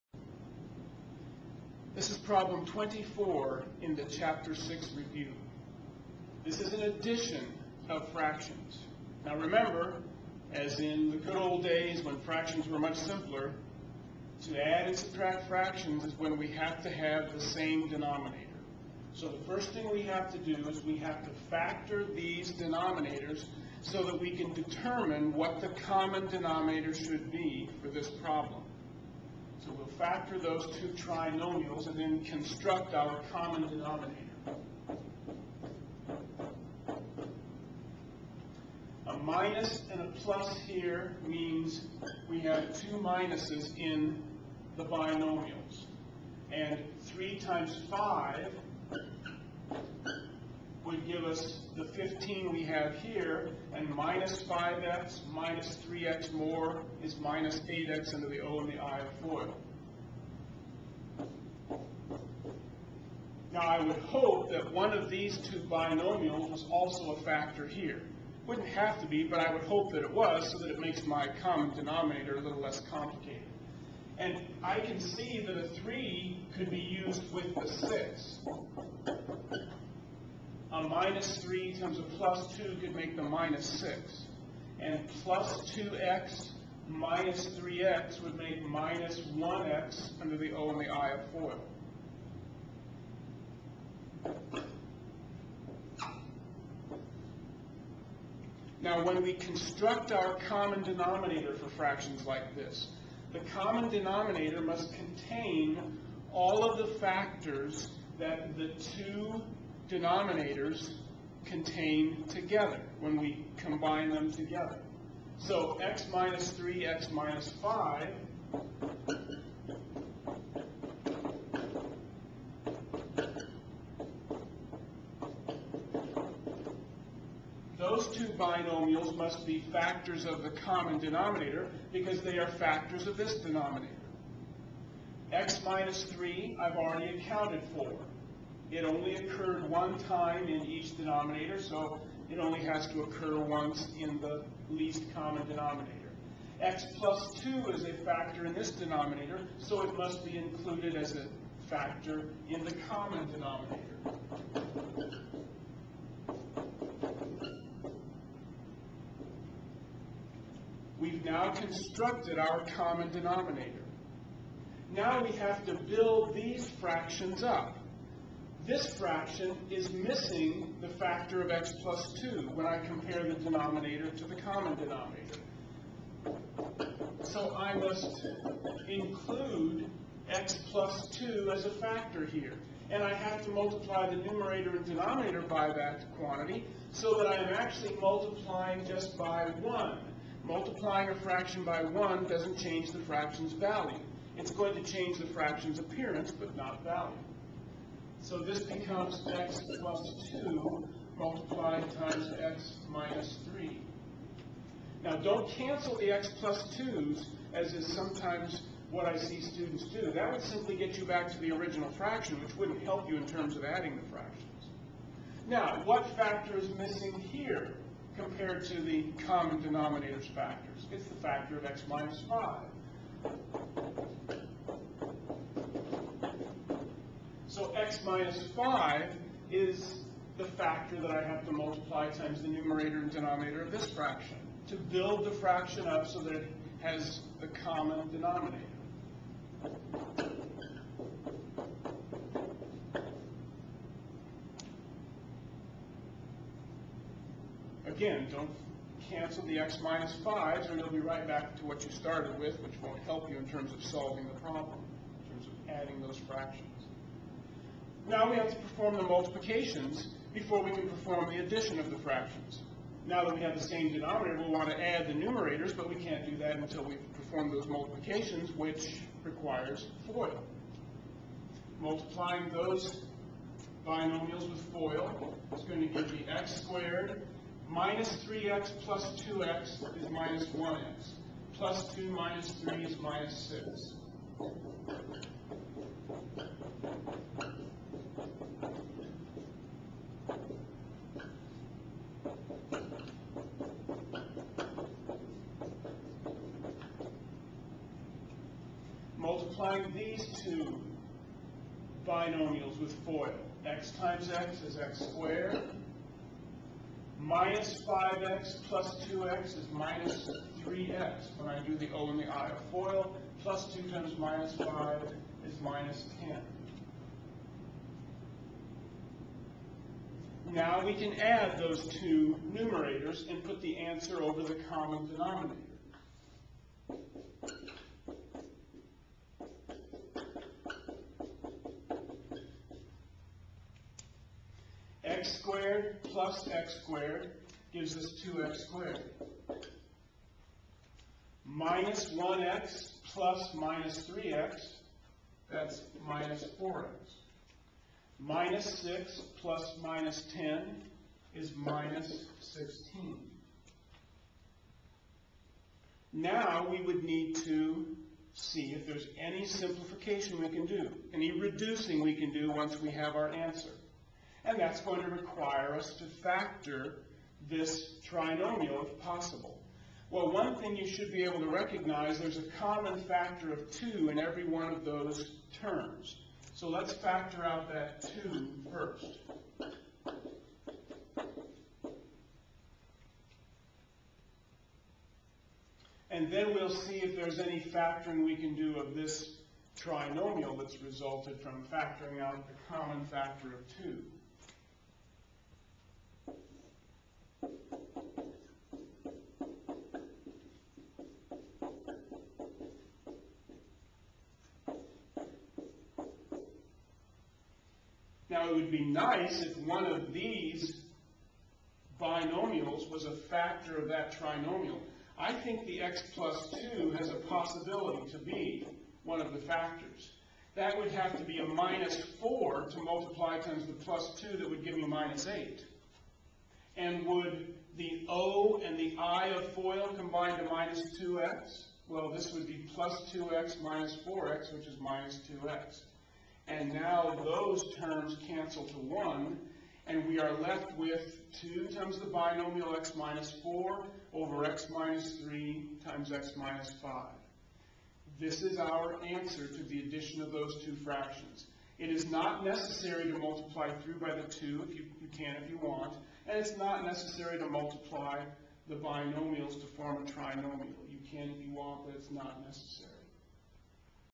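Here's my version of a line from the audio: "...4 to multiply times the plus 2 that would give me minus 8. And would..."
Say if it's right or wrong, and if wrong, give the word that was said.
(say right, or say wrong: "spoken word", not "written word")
right.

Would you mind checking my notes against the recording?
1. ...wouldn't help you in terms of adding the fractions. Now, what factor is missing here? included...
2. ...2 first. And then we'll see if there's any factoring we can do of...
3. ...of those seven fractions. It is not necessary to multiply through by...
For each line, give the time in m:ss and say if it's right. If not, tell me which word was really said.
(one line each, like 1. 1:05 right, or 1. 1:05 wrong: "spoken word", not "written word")
1. 3:32 wrong: "compared", not "included"
2. 6:18 right
3. 7:30 wrong: "two", not "seven".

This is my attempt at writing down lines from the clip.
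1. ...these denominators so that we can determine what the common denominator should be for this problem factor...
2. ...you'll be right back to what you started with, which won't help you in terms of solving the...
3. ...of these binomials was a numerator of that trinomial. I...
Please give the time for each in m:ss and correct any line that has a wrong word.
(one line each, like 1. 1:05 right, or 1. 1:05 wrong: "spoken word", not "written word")
1. 0:22 right
2. 4:10 right
3. 6:49 wrong: "factor", not "numerator".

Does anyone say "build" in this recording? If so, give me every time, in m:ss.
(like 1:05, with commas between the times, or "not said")
2:45, 3:54.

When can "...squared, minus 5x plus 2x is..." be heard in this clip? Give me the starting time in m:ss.
5:04.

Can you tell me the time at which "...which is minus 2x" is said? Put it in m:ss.
7:14.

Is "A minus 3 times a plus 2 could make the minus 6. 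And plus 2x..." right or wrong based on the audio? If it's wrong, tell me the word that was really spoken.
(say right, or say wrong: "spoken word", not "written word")
right.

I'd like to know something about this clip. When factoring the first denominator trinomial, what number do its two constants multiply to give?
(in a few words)
15.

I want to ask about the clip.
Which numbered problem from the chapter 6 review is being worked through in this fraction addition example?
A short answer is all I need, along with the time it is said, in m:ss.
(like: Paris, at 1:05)
24, at 0:02.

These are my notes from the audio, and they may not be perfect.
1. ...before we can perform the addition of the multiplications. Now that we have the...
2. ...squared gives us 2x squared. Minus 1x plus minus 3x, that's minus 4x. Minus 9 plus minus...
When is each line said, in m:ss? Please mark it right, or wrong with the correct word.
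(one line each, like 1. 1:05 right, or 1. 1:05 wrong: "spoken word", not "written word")
1. 4:20 wrong: "fractions", not "multiplications"
2. 5:36 wrong: "6", not "9".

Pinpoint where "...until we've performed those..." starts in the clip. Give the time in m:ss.
4:26.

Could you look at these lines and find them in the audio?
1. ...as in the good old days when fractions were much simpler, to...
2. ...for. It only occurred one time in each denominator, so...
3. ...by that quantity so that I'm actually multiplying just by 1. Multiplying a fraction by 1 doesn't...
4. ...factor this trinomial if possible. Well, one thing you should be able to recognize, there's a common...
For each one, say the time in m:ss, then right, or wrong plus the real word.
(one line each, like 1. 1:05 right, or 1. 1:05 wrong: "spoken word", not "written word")
1. 0:10 right
2. 2:17 right
3. 3:05 right
4. 6:06 right.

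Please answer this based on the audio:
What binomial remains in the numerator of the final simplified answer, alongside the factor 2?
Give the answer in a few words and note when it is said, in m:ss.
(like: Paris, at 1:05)
x - 4, at 7:22.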